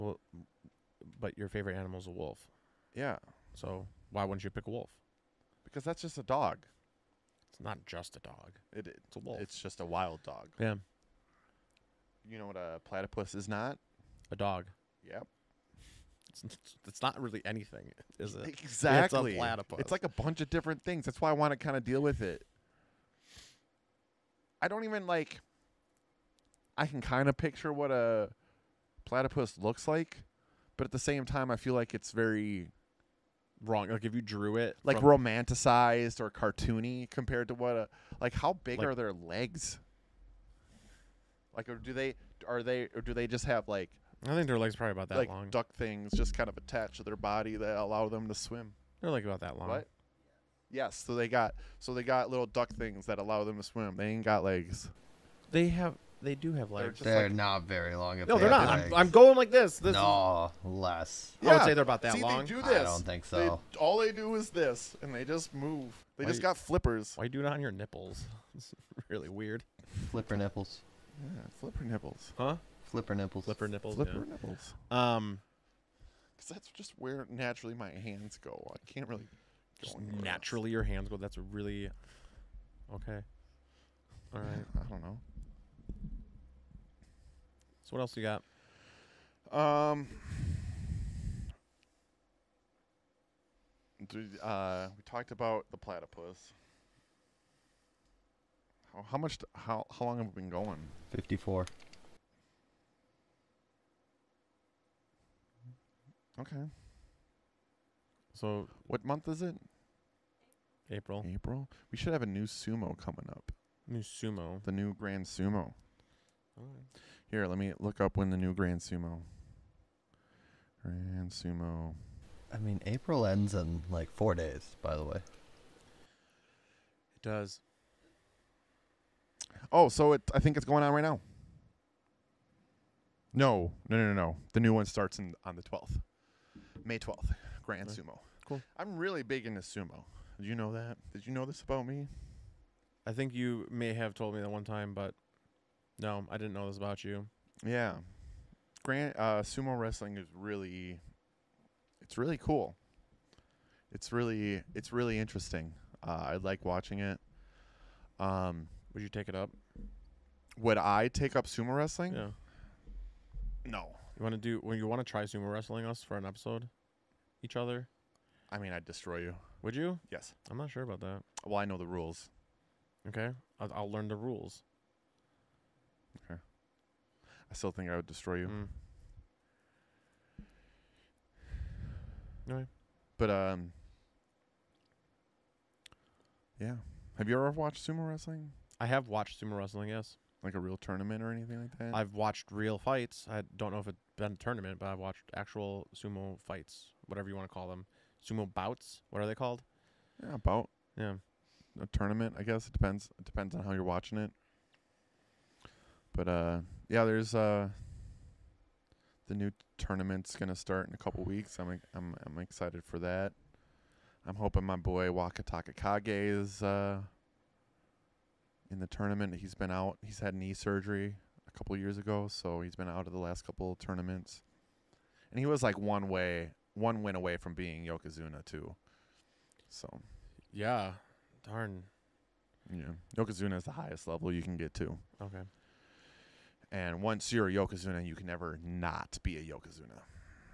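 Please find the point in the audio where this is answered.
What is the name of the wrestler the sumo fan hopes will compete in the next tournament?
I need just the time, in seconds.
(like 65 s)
215 s.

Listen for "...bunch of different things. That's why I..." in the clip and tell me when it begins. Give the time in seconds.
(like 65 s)
20 s.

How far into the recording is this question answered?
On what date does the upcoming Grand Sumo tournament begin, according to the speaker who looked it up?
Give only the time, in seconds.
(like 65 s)
136 s.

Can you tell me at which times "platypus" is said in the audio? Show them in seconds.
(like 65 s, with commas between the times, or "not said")
12 s, 19 s, 29 s, 95 s.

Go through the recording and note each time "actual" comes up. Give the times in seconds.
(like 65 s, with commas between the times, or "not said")
195 s.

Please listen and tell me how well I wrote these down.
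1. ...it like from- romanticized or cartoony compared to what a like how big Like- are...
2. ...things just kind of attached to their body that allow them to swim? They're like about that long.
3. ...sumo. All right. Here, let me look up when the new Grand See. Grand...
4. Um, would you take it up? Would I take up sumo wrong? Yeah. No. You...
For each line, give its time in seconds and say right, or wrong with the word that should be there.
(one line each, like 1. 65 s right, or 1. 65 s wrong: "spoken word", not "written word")
1. 34 s right
2. 45 s right
3. 115 s wrong: "Sumo", not "See"
4. 158 s wrong: "wrestling", not "wrong".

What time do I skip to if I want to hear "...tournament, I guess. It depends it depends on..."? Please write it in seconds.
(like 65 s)
201 s.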